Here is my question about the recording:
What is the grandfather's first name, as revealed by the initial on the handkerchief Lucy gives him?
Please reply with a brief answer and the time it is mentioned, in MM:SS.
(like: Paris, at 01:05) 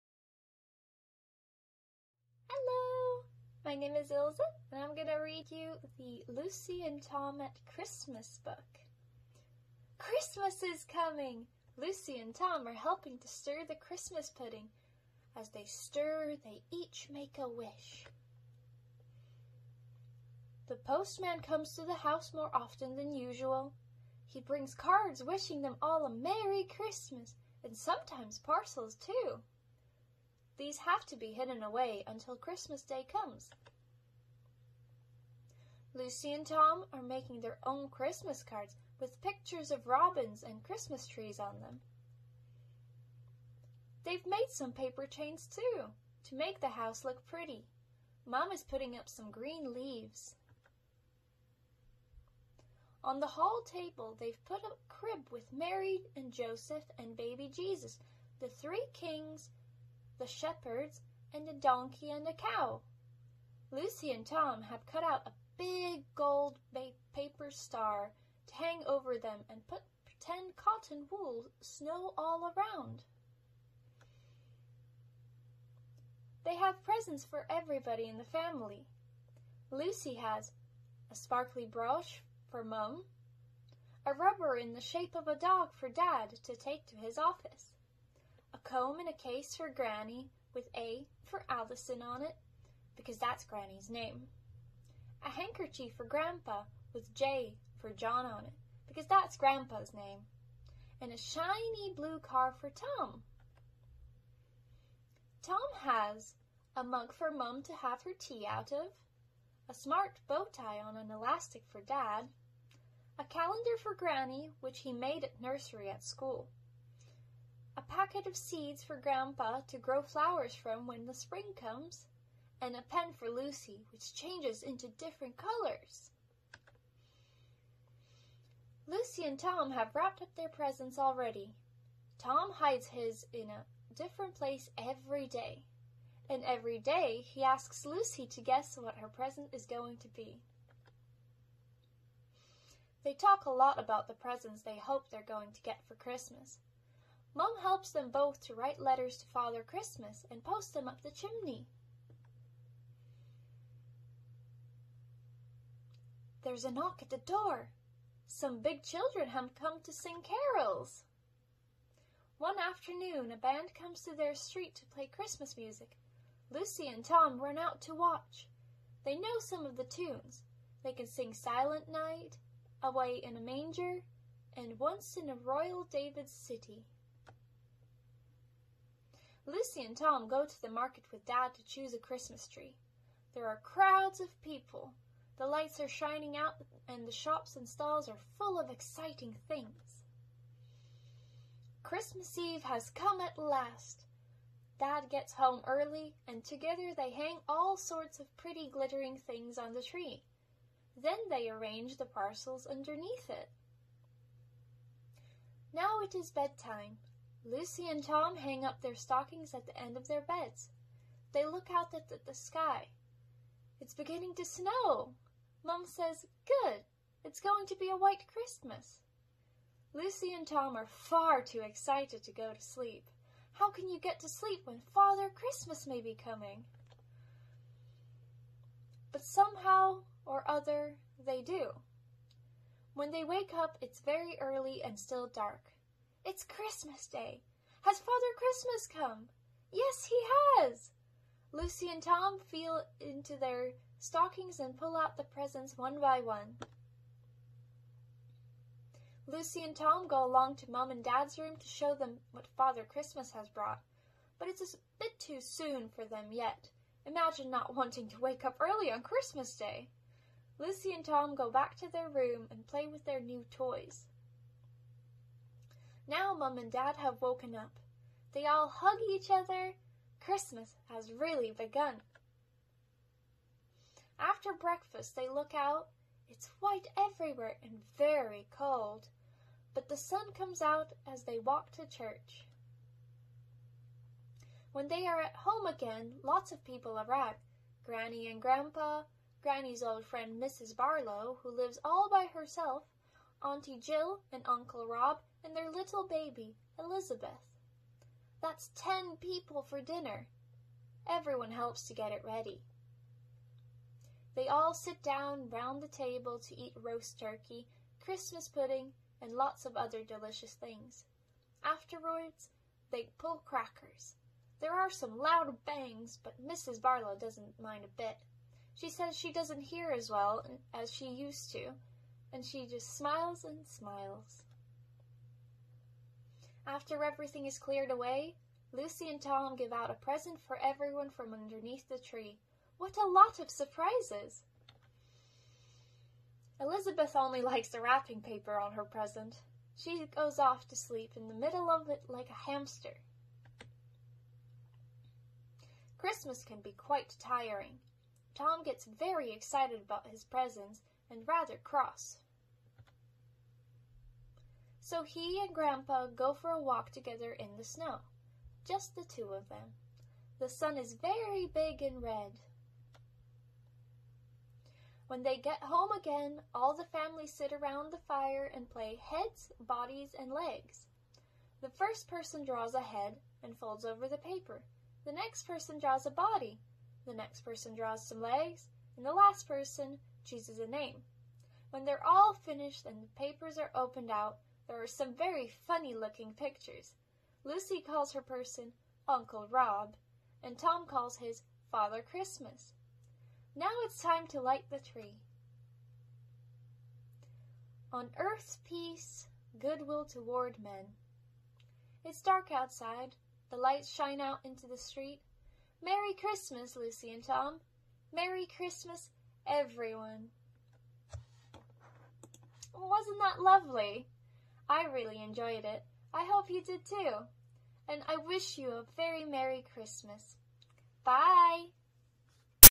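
John, at 01:37.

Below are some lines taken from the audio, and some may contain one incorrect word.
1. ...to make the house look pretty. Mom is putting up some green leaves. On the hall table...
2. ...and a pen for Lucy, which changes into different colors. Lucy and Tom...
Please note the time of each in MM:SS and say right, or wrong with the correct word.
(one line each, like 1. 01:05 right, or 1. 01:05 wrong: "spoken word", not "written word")
1. 00:46 right
2. 02:02 right.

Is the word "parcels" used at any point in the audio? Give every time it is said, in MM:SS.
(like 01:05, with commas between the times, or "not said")
00:28, 03:22.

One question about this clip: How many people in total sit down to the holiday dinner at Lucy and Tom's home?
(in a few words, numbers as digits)
10.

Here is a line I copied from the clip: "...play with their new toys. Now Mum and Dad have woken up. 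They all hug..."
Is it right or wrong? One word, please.
right.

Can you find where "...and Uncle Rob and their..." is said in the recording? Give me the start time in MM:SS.
04:54.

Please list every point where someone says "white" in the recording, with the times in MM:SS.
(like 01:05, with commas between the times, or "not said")
03:37, 04:36.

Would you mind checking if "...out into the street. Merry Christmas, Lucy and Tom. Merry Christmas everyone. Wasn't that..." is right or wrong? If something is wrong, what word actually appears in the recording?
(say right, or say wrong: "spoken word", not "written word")
right.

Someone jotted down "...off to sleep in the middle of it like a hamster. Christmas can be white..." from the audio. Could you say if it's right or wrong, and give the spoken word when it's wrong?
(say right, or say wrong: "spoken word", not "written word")
wrong: "quite", not "white".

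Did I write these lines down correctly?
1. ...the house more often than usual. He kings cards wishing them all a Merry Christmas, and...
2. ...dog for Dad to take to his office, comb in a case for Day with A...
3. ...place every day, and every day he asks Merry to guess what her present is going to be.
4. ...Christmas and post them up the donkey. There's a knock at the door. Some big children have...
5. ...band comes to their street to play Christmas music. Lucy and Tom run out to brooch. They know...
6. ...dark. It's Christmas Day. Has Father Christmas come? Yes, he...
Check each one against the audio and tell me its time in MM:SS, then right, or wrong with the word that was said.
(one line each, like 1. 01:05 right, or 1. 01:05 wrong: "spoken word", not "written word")
1. 00:21 wrong: "brings", not "kings"
2. 01:25 wrong: "Granny", not "Day"
3. 02:14 wrong: "Lucy", not "Merry"
4. 02:29 wrong: "chimney", not "donkey"
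5. 02:43 wrong: "watch", not "brooch"
6. 03:55 right.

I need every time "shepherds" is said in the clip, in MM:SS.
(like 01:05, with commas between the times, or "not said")
01:00.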